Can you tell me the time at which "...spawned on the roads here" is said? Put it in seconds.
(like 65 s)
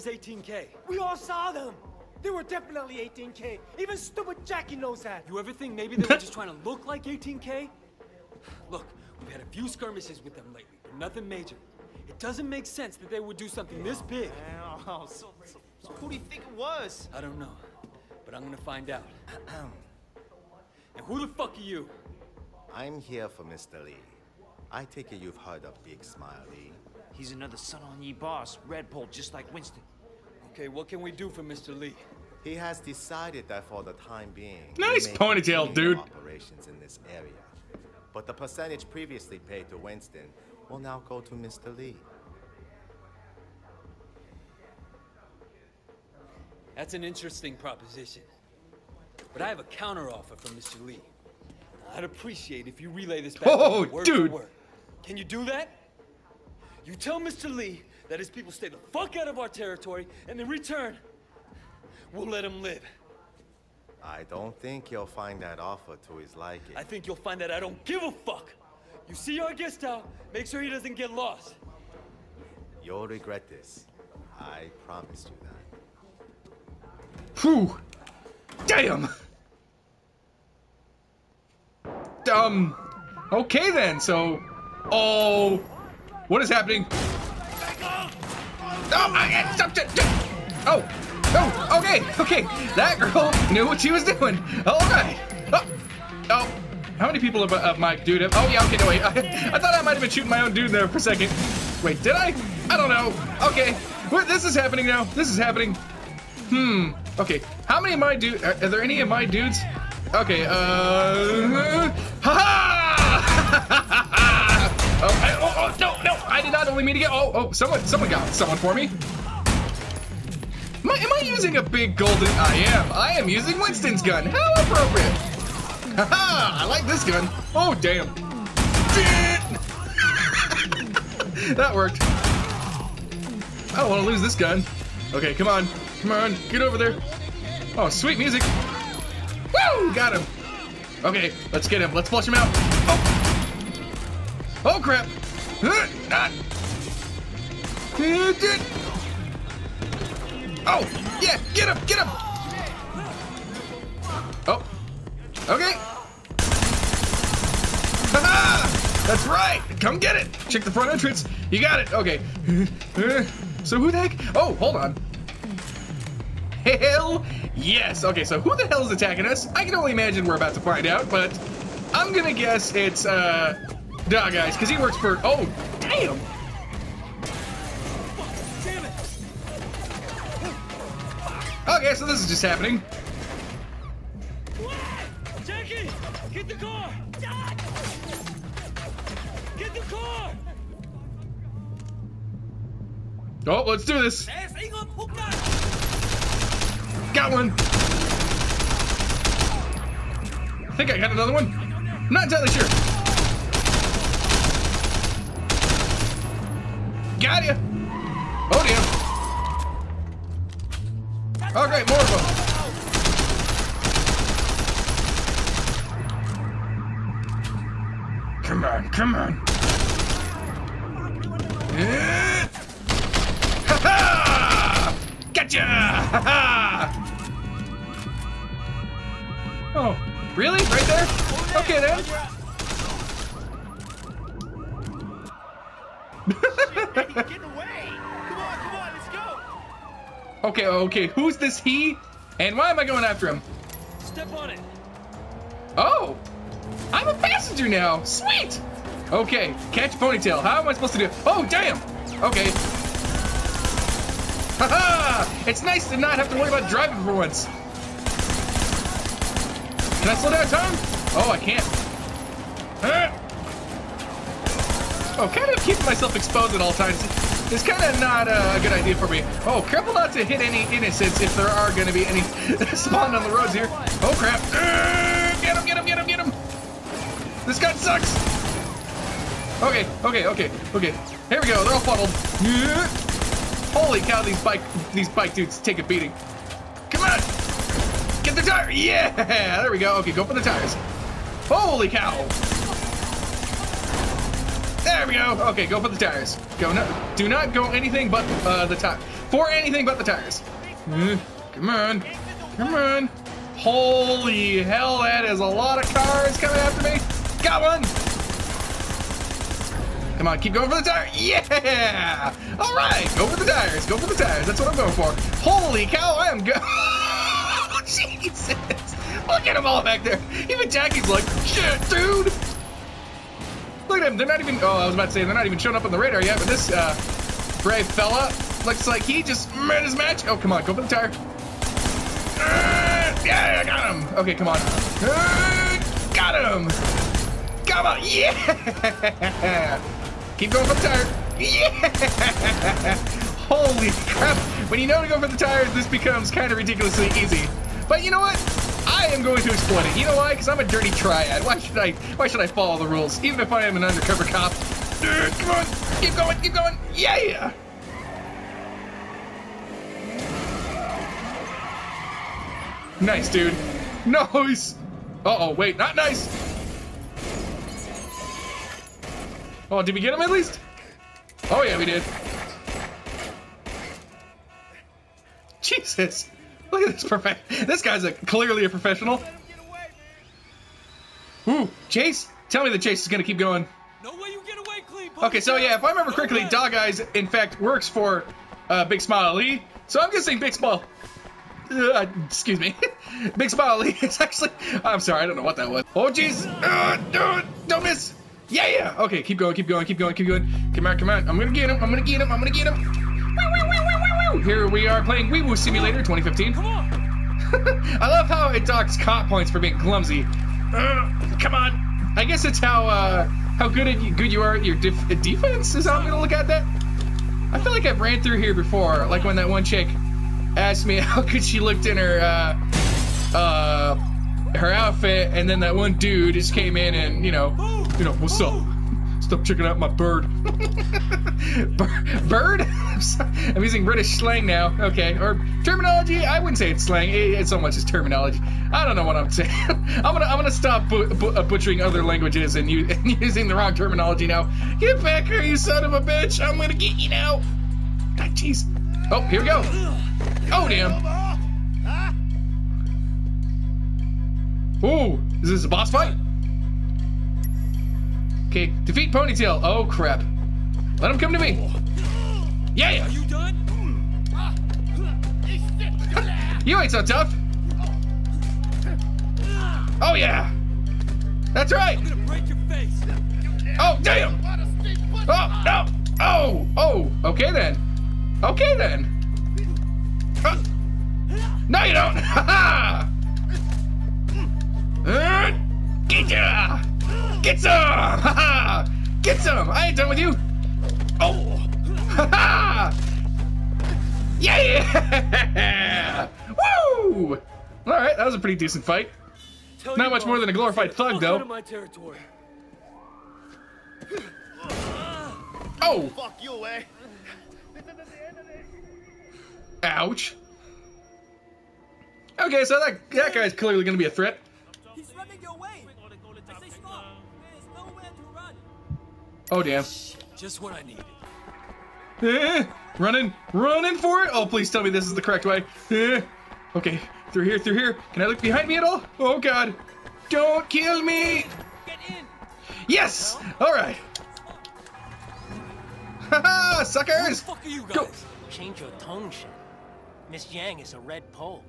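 272 s.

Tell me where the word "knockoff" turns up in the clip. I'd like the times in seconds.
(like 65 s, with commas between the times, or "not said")
not said.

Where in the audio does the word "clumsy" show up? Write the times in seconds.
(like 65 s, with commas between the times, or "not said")
409 s.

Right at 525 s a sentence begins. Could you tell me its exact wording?
Eh, okay, through here, through here.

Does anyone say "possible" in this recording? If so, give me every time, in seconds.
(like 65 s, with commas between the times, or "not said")
not said.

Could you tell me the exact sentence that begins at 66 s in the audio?
I think you'll find that I don't give a fuck.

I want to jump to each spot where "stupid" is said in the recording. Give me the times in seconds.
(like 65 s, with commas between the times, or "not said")
3 s.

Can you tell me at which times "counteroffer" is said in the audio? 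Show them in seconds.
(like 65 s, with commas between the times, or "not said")
49 s.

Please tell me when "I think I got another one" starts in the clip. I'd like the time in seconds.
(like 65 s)
200 s.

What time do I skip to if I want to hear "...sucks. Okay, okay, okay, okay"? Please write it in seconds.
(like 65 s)
277 s.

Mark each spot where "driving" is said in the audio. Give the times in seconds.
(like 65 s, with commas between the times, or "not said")
256 s.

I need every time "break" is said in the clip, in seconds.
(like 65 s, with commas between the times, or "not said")
472 s.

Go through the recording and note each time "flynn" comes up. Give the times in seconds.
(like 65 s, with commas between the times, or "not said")
not said.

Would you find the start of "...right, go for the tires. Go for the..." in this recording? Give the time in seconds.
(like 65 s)
312 s.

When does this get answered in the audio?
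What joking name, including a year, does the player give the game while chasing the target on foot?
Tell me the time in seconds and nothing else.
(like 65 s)
405 s.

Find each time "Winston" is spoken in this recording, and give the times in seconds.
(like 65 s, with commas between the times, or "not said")
29 s, 39 s, 123 s.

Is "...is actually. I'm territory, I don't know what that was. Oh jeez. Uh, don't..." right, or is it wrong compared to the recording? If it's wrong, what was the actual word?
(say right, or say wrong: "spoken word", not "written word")
wrong: "sorry", not "territory".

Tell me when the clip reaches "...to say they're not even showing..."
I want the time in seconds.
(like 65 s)
325 s.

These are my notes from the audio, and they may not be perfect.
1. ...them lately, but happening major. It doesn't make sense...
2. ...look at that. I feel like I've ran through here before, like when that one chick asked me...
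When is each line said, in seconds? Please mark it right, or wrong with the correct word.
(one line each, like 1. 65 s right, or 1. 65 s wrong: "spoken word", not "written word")
1. 10 s wrong: "nothing", not "happening"
2. 416 s right.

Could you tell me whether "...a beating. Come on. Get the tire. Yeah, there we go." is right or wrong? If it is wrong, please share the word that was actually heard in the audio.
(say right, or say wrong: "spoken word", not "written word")
right.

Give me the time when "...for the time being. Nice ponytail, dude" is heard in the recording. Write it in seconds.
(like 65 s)
33 s.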